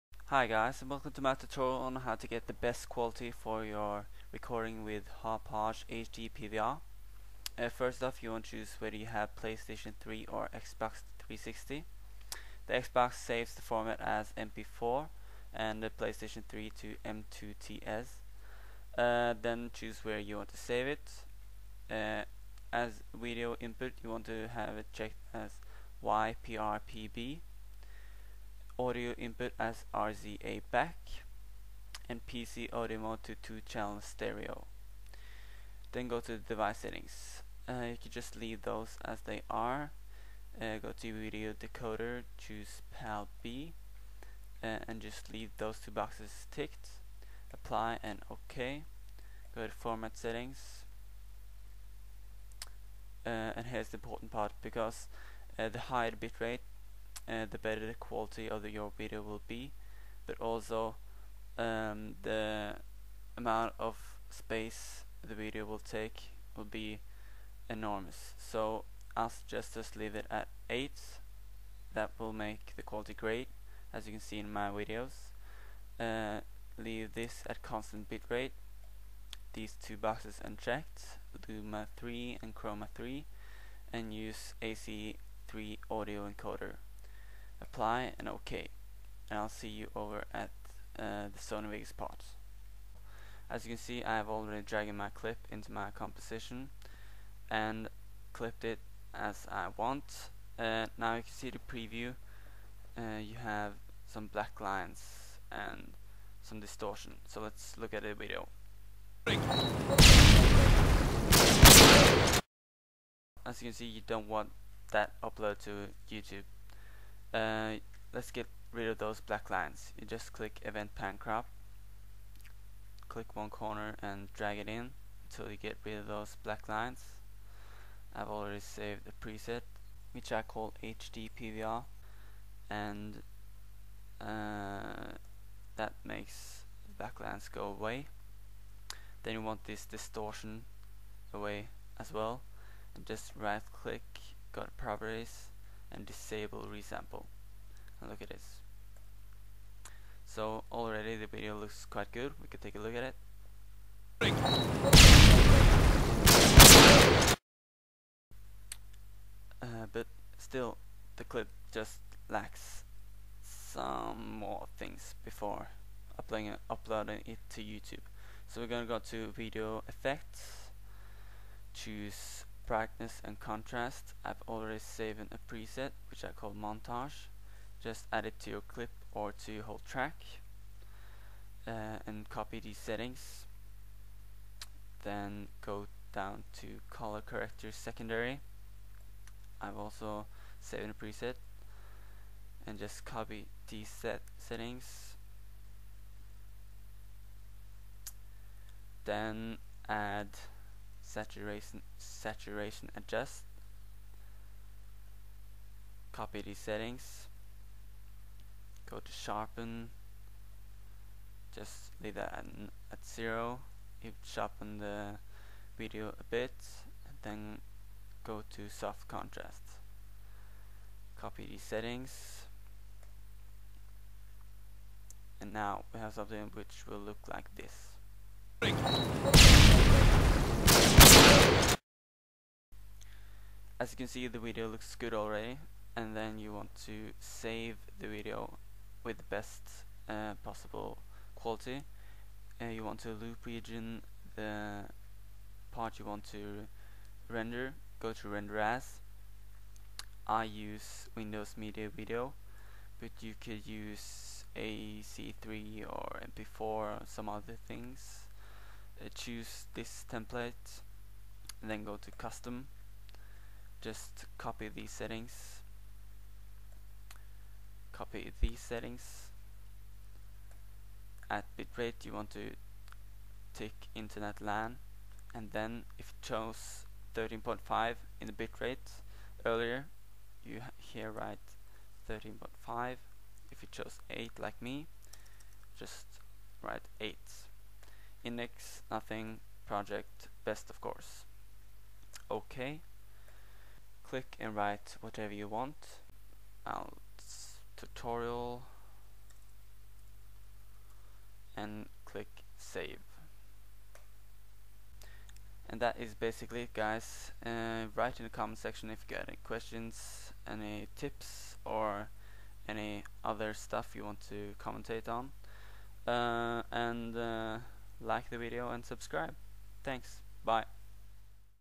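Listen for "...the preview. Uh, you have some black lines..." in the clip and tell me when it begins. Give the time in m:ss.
1:41.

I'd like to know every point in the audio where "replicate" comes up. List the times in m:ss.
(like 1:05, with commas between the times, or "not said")
not said.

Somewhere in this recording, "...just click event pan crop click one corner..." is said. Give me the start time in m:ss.
2:00.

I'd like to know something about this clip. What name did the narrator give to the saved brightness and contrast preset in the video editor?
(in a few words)
montage.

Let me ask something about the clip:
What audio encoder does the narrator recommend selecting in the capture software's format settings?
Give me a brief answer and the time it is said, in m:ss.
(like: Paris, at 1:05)
AC3, at 1:24.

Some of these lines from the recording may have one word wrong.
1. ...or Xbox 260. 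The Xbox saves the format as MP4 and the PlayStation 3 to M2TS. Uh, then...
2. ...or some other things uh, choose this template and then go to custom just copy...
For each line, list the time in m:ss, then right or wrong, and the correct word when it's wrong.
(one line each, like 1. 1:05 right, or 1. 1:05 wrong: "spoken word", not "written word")
1. 0:10 wrong: "360", not "260"
2. 4:16 right.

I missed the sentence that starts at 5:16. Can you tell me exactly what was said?
Uh, and uh, like the video and subscribe.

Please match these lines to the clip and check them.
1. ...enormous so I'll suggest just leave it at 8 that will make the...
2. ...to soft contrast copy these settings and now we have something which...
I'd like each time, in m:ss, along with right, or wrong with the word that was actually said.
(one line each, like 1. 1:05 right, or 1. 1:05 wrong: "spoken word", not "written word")
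1. 1:07 right
2. 3:38 right.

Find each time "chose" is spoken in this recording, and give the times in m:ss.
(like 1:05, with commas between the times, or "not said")
4:36, 4:43.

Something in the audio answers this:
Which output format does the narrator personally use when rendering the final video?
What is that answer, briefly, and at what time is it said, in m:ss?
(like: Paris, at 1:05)
Windows Media Video, at 4:11.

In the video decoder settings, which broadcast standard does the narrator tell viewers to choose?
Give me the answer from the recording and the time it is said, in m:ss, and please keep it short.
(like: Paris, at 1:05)
PAL B, at 0:42.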